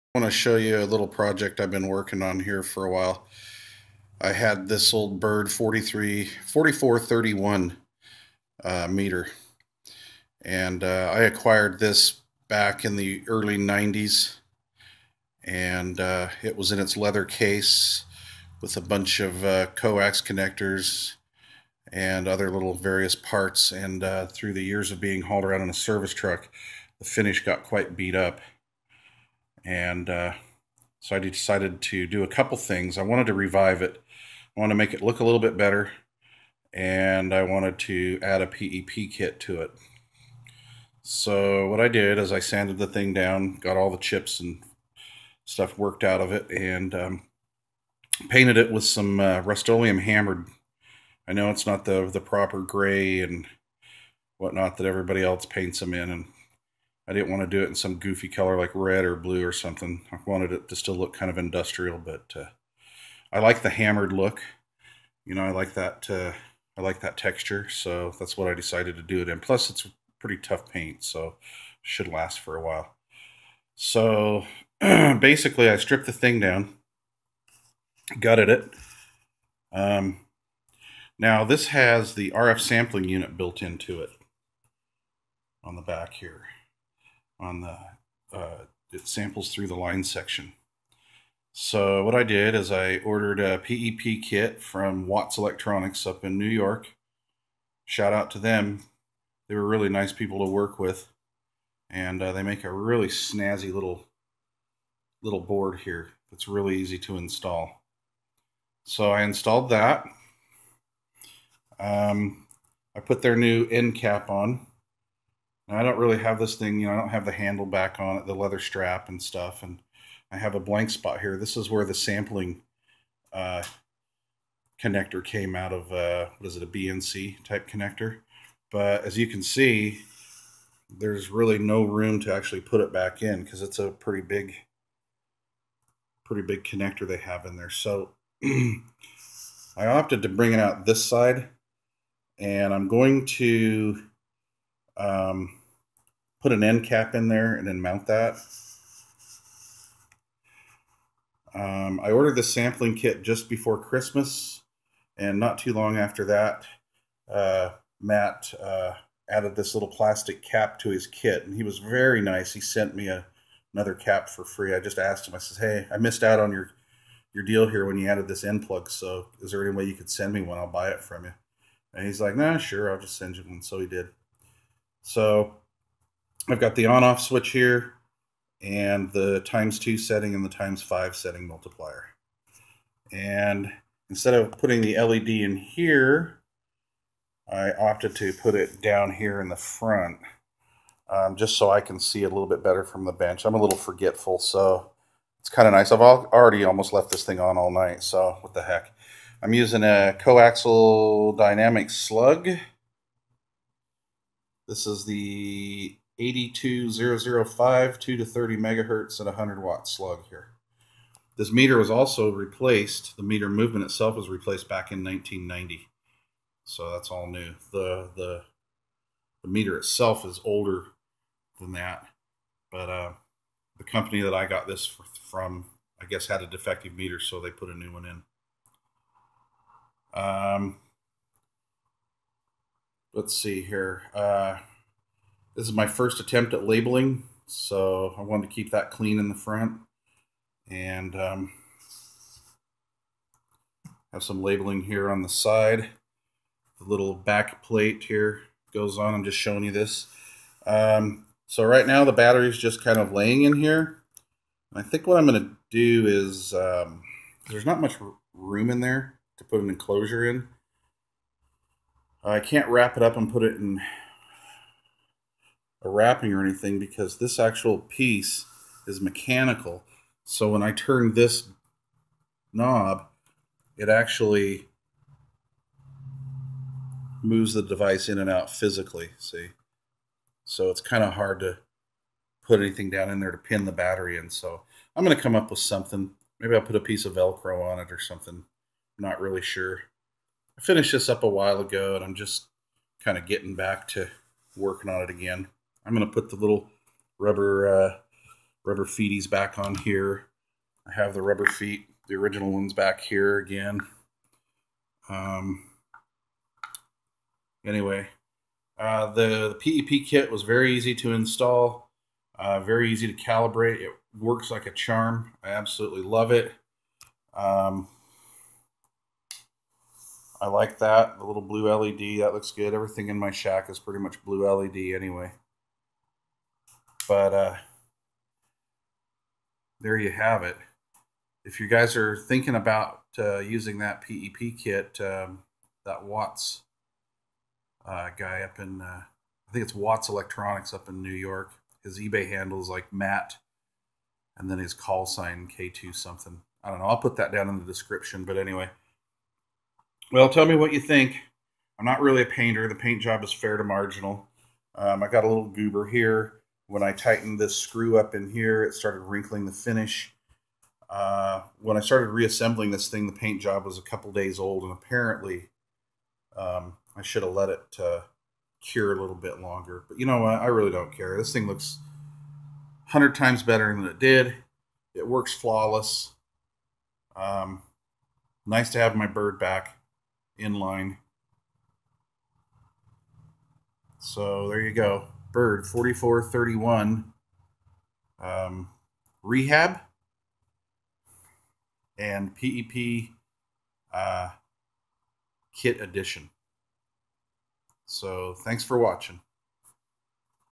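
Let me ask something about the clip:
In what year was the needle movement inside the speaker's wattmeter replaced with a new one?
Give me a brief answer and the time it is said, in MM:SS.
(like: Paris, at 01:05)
1990, at 03:35.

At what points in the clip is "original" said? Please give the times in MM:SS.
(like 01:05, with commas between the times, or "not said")
05:02.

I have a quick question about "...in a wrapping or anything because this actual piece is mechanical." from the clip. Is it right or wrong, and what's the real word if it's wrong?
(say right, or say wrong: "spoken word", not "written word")
right.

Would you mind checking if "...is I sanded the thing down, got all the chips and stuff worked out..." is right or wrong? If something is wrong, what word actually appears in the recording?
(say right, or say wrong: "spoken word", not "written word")
right.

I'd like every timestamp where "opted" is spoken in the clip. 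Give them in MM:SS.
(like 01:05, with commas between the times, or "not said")
02:19, 03:07.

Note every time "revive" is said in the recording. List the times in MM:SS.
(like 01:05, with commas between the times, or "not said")
00:33.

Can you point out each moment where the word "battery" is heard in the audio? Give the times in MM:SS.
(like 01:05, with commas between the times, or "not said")
04:12, 04:43.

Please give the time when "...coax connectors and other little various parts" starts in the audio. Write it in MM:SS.
00:19.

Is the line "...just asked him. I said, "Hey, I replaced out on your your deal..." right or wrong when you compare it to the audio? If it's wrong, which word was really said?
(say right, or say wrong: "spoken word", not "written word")
wrong: "missed", not "replaced".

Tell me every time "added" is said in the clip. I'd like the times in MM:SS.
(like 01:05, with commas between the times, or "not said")
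02:39, 02:48.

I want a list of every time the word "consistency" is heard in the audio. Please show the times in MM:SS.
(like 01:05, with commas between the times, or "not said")
not said.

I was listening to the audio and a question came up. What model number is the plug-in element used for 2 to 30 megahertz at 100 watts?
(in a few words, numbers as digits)
82005.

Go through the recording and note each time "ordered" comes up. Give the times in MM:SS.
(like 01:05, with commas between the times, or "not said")
01:32, 02:32.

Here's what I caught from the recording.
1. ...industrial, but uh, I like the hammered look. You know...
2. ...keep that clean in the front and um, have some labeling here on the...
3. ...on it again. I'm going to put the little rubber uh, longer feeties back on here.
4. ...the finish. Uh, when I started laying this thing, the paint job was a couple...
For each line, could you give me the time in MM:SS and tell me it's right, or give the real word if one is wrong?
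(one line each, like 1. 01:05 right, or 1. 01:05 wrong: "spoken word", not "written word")
1. 01:01 right
2. 03:58 right
3. 04:54 wrong: "rubber", not "longer"
4. 05:59 wrong: "reassembling", not "laying".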